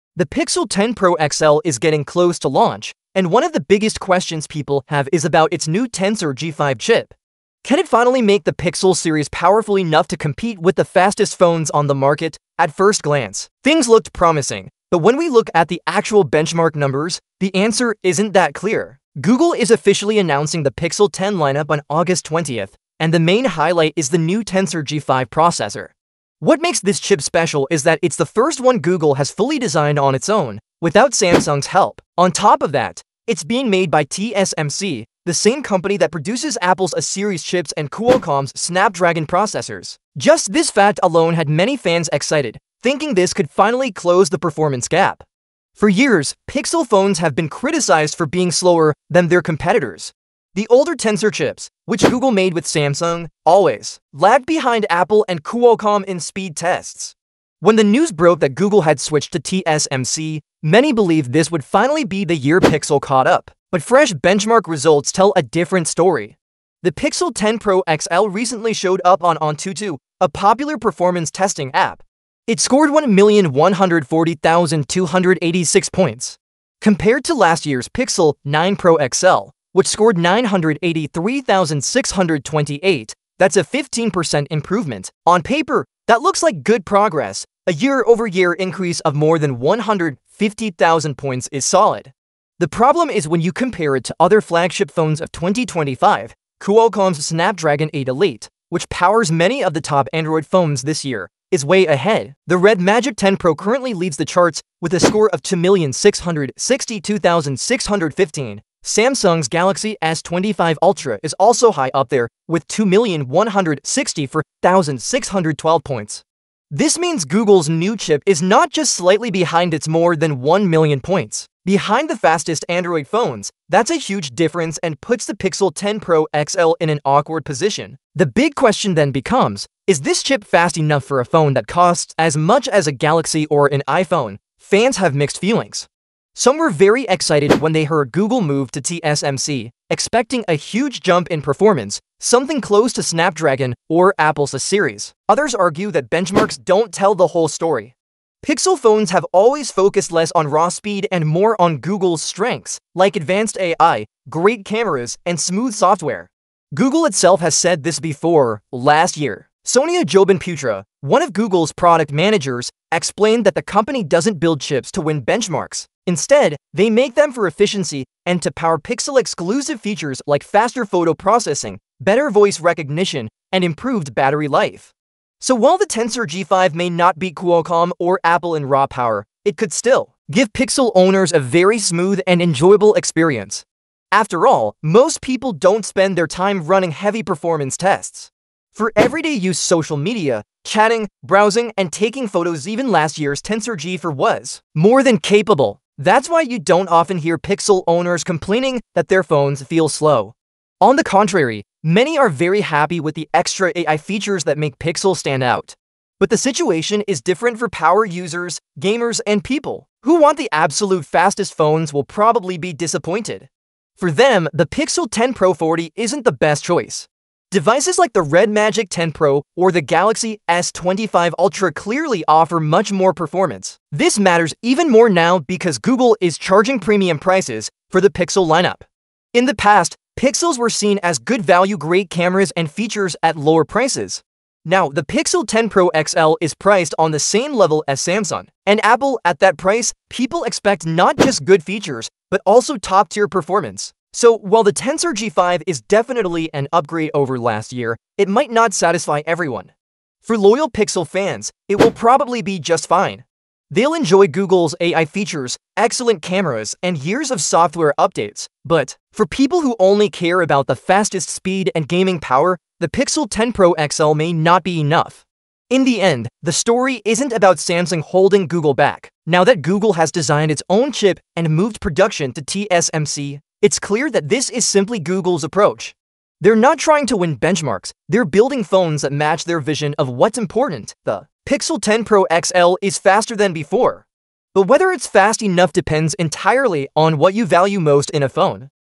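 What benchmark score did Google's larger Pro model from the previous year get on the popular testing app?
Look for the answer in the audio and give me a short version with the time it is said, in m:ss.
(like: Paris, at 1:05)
983,628, at 1:20.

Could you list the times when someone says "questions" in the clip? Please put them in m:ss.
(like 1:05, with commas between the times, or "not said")
0:04, 2:08.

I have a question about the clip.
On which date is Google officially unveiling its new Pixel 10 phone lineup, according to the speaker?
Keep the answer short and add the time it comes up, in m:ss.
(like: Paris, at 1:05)
August 20th, at 0:21.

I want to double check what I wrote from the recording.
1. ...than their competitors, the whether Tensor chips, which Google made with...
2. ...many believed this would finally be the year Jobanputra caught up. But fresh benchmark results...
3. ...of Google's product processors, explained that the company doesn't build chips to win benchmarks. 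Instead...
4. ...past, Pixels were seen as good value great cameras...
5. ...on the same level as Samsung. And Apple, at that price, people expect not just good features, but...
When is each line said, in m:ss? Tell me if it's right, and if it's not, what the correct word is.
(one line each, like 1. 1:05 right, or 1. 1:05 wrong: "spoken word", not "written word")
1. 0:49 wrong: "older", not "whether"
2. 1:00 wrong: "Pixel", not "Jobanputra"
3. 2:41 wrong: "managers", not "processors"
4. 3:49 right
5. 3:56 right.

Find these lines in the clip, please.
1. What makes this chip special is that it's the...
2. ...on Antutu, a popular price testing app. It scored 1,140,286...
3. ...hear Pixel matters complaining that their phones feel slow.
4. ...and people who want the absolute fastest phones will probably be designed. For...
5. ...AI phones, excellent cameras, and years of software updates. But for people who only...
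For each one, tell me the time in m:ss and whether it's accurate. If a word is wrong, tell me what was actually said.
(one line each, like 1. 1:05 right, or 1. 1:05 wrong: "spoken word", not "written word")
1. 0:26 right
2. 1:09 wrong: "performance", not "price"
3. 3:17 wrong: "owners", not "matters"
4. 3:29 wrong: "disappointed", not "designed"
5. 4:14 wrong: "features", not "phones".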